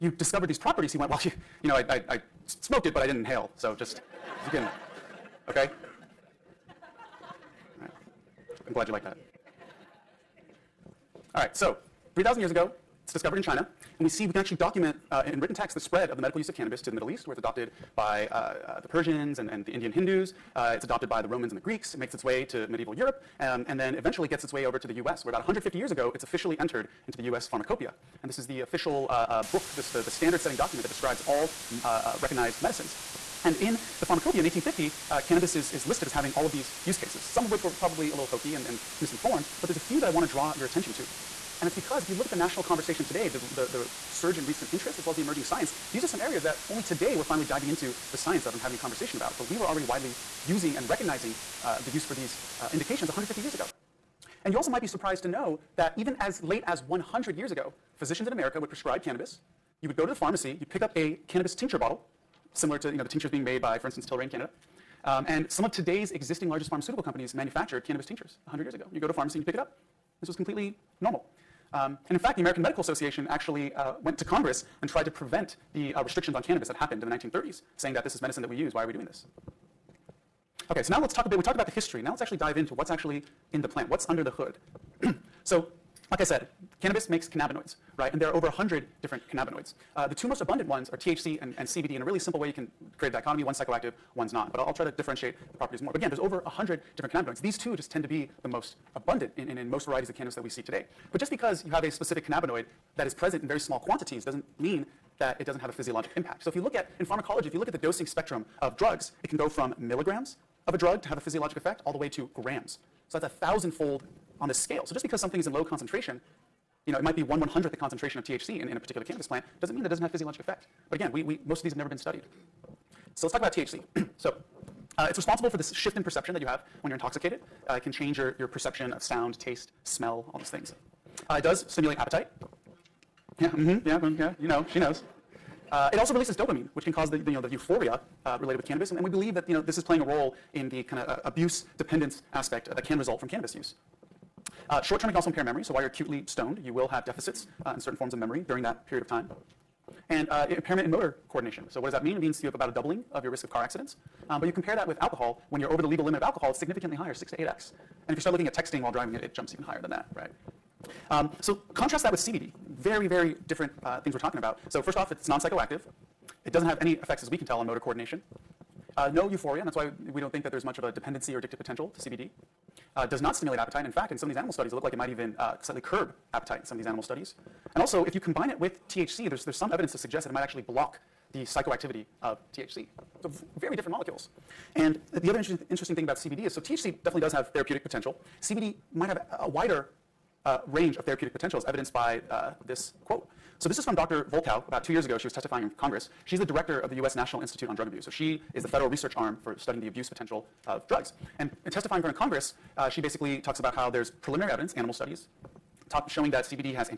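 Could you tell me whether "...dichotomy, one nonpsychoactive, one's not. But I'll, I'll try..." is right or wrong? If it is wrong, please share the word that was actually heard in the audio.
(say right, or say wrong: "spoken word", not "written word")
wrong: "psychoactive", not "nonpsychoactive".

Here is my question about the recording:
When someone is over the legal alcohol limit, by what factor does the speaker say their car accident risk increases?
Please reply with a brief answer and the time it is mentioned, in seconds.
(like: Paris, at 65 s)
6 to 8x, at 157 s.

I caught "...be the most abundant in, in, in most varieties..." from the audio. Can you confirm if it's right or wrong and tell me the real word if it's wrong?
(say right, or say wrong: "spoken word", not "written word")
right.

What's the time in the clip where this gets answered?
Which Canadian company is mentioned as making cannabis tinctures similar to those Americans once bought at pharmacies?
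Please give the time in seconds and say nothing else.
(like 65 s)
64 s.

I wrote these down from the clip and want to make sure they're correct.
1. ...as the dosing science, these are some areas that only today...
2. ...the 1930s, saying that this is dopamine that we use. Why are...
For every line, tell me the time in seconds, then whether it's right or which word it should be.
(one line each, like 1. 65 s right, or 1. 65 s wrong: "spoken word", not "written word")
1. 45 s wrong: "emerging", not "dosing"
2. 77 s wrong: "medicine", not "dopamine".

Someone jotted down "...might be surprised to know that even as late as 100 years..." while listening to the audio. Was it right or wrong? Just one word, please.
right.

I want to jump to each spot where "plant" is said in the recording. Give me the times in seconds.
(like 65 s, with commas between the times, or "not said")
83 s, 119 s.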